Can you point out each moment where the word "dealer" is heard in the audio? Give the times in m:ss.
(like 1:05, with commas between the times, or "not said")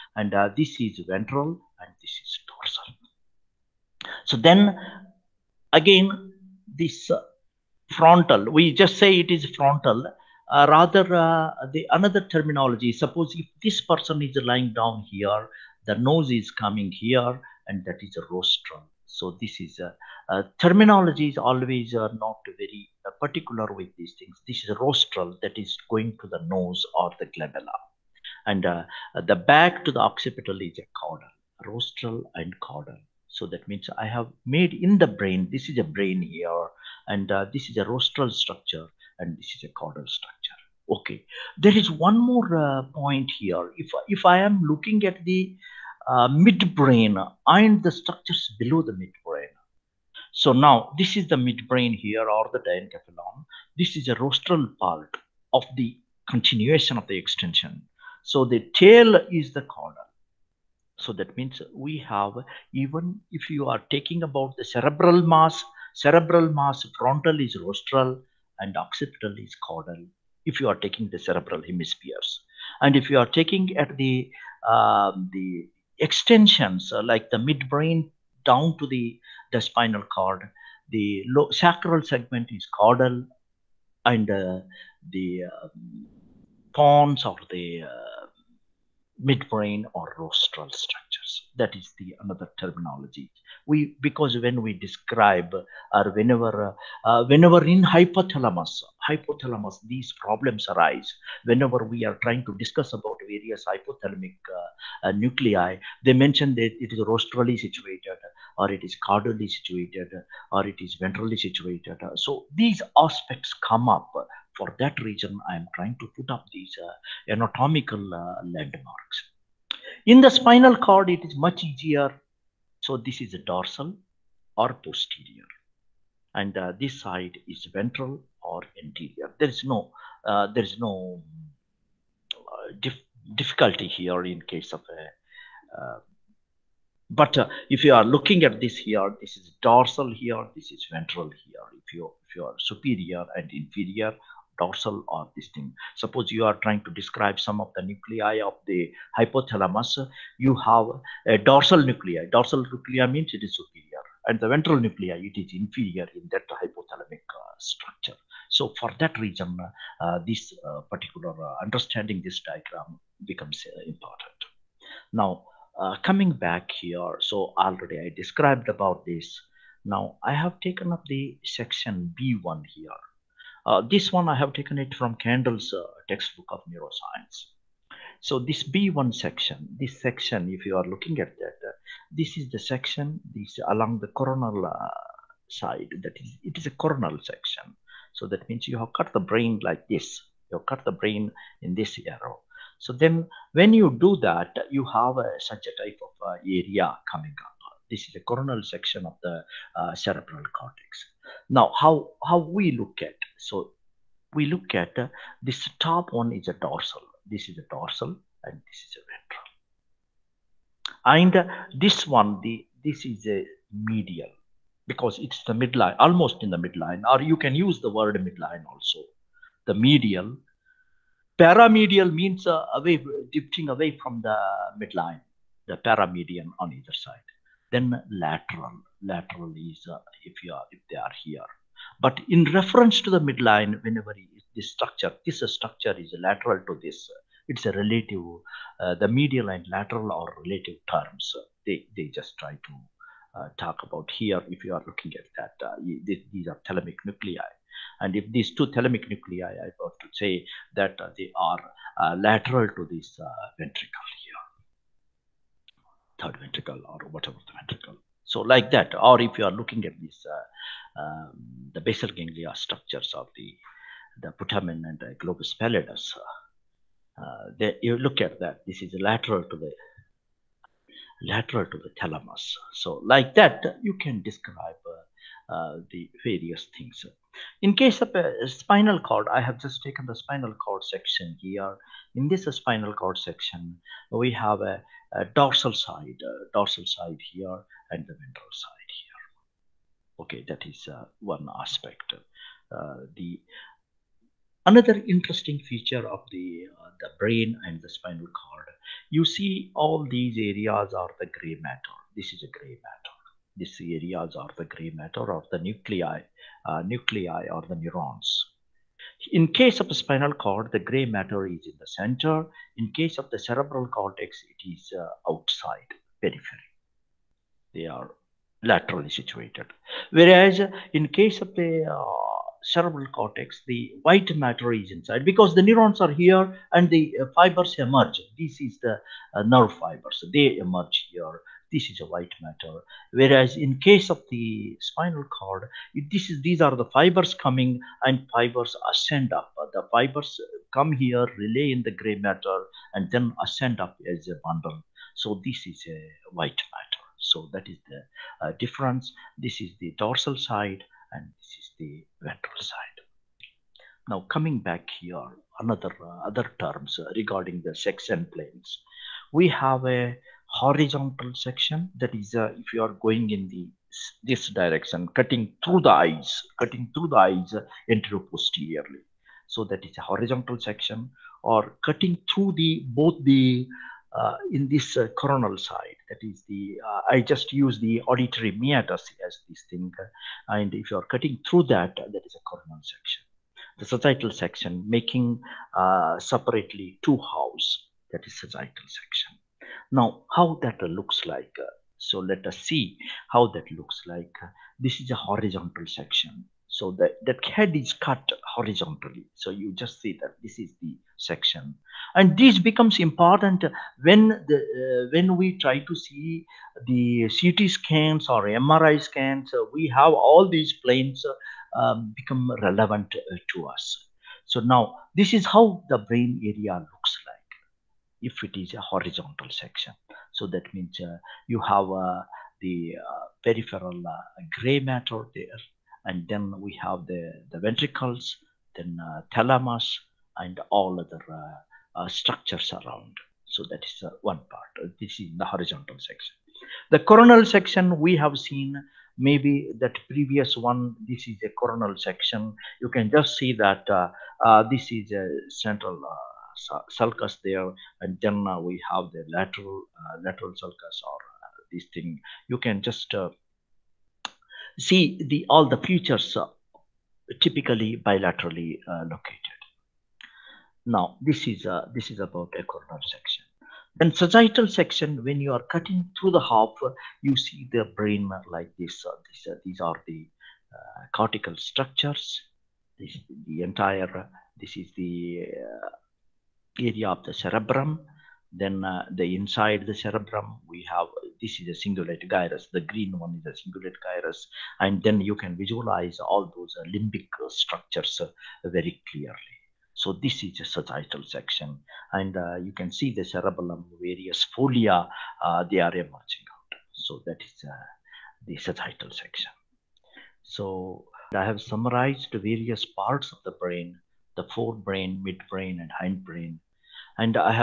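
not said.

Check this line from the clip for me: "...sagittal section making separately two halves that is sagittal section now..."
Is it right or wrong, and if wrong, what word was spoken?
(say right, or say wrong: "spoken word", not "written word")
right.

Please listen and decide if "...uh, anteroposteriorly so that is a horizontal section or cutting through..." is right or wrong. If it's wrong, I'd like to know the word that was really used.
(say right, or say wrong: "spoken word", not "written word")
right.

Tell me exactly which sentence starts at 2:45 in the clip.
Now uh, coming back here, so already I described about this.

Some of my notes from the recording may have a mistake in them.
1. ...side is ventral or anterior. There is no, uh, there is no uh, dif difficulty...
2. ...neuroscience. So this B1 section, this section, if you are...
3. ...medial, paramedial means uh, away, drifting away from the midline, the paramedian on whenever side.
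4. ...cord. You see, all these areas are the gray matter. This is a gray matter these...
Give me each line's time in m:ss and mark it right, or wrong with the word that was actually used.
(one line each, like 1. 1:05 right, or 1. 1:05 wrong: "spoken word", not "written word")
1. 2:07 right
2. 2:56 right
3. 3:39 wrong: "either", not "whenever"
4. 4:58 right.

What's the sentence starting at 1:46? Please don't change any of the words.
They mention that it is rostrally situated or it is caudally situated or it is ventrally situated.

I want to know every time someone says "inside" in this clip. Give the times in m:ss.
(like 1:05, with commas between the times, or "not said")
5:24, 7:59.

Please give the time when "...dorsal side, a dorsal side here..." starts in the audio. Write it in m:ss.
4:45.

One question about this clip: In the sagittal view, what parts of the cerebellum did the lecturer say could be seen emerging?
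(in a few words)
Folia.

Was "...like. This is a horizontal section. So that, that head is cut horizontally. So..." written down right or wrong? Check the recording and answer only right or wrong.
right.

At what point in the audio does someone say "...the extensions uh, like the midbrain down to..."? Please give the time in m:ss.
1:15.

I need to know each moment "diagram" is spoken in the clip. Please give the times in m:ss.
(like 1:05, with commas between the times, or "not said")
2:42.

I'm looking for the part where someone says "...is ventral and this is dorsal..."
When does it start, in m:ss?
0:00.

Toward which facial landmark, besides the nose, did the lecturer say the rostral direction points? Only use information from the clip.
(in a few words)
Glabella.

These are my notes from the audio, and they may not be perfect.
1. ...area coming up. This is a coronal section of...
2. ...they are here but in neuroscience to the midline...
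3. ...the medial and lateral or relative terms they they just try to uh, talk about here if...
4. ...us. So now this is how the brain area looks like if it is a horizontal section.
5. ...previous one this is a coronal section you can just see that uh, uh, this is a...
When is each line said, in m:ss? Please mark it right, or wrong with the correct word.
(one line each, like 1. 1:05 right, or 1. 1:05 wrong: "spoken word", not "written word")
1. 3:16 right
2. 3:50 wrong: "reference", not "neuroscience"
3. 3:59 right
4. 6:53 right
5. 7:20 right.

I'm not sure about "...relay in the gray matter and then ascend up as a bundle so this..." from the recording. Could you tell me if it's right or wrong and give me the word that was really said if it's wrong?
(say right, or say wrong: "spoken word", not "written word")
right.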